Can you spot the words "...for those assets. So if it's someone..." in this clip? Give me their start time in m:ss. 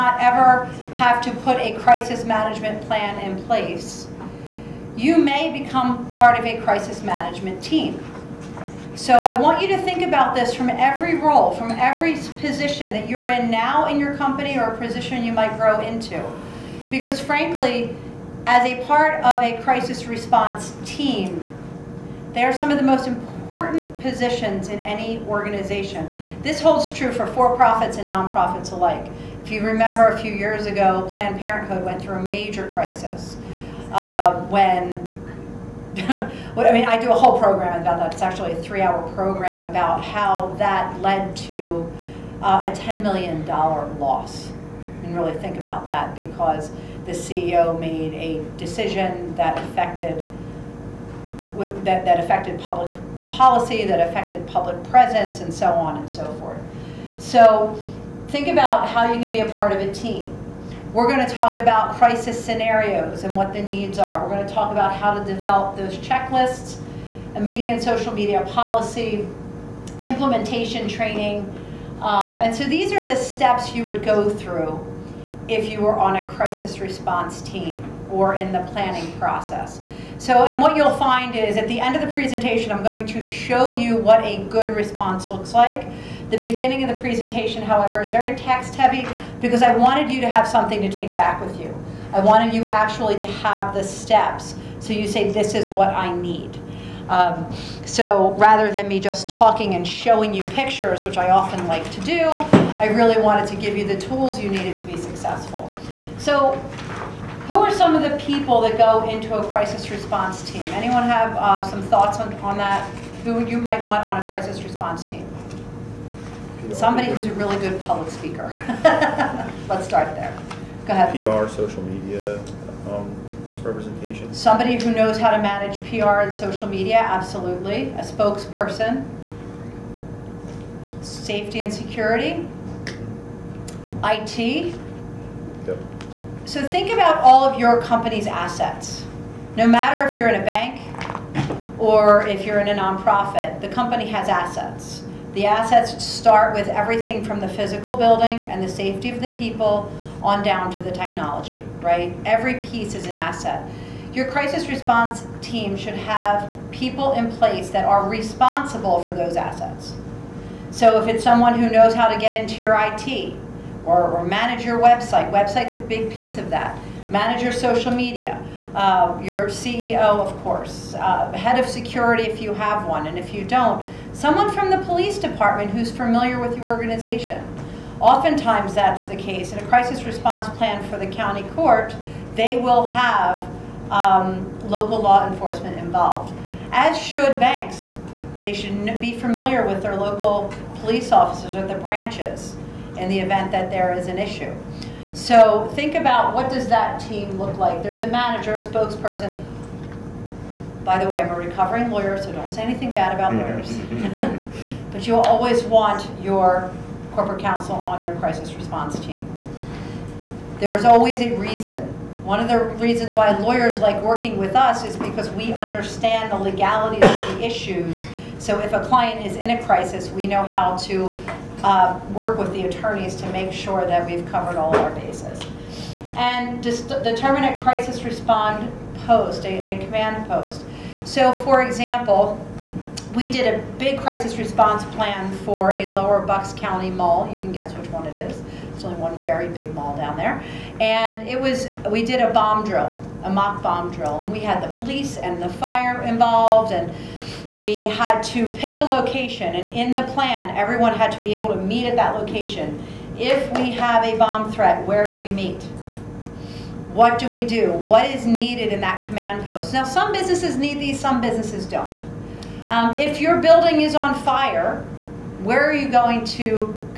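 2:39.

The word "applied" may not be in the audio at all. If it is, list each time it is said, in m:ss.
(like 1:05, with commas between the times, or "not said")
not said.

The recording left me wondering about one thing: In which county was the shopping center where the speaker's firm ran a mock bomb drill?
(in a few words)
Lower Bucks County.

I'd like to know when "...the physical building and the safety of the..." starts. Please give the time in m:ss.
2:27.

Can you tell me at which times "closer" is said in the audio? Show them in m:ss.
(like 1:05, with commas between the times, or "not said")
not said.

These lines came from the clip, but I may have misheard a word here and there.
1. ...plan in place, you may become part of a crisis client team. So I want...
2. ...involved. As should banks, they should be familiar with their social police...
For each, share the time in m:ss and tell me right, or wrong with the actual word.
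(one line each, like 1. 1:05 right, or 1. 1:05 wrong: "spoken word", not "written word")
1. 0:02 wrong: "management", not "client"
2. 3:05 wrong: "local", not "social".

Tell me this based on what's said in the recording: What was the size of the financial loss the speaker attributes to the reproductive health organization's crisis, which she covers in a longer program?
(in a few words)
$10 million.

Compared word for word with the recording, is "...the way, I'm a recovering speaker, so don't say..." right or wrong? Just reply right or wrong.
wrong.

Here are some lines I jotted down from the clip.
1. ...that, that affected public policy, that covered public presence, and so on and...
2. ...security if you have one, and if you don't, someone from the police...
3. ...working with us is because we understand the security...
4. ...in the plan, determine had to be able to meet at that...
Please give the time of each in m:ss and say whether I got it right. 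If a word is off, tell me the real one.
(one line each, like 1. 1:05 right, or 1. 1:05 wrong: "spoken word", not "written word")
1. 0:51 wrong: "affected", not "covered"
2. 2:51 right
3. 3:34 wrong: "legality", not "security"
4. 4:09 wrong: "everyone", not "determine".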